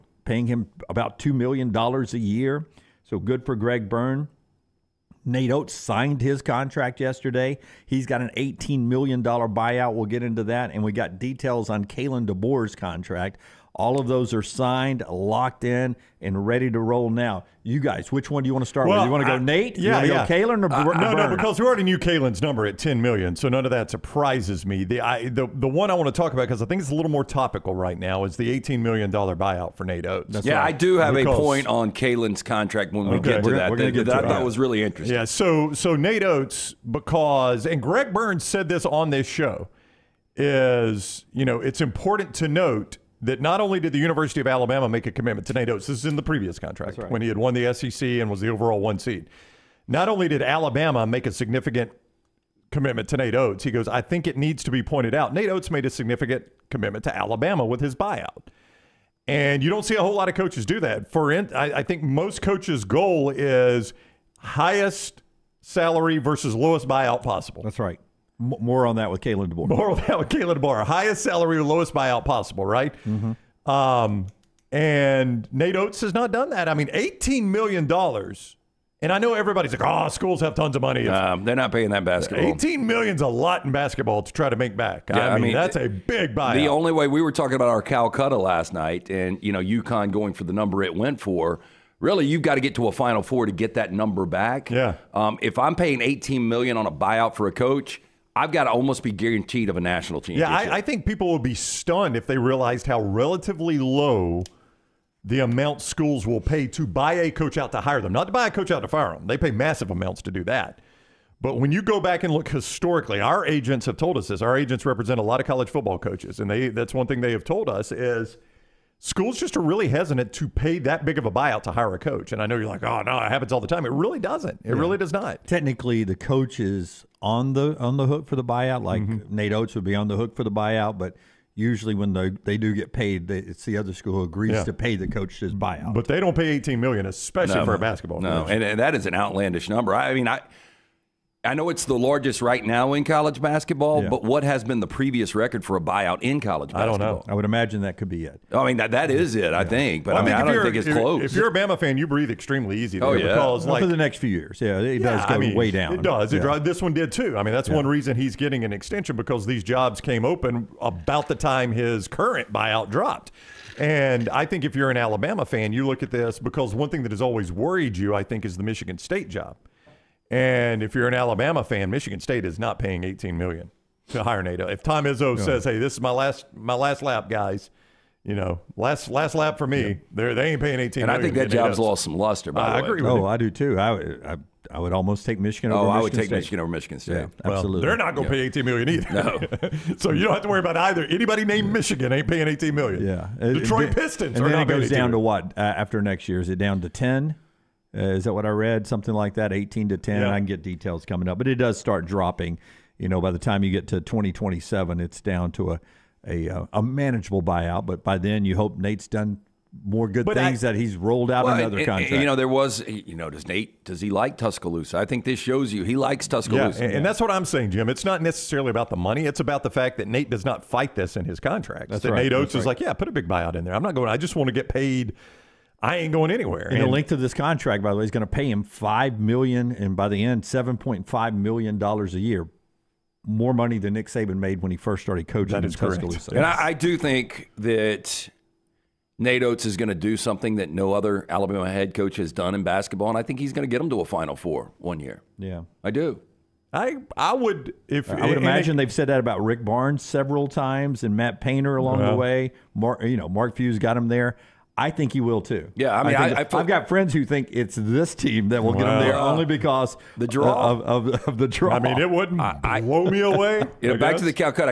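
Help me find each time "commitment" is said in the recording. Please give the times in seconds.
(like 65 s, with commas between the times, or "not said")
45 s, 52 s, 56 s.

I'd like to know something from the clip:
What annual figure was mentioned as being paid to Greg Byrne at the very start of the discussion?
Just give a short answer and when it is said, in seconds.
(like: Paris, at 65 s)
$2 million, at 1 s.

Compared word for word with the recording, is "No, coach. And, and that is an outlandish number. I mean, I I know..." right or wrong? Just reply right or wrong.
right.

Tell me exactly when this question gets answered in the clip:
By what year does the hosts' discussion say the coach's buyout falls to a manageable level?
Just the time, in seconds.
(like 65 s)
203 s.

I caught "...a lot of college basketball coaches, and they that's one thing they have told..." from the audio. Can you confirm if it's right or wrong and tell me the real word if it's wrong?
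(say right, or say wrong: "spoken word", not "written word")
wrong: "football", not "basketball".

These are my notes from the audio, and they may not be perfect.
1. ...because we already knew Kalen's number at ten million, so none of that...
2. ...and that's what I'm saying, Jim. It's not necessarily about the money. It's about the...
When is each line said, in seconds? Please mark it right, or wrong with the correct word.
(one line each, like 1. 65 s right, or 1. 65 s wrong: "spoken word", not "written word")
1. 21 s right
2. 216 s right.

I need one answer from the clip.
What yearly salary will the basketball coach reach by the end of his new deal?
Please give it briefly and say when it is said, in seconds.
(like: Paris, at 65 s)
$7.5 million, at 230 s.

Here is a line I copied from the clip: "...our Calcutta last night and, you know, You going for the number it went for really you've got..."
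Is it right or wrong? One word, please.
wrong.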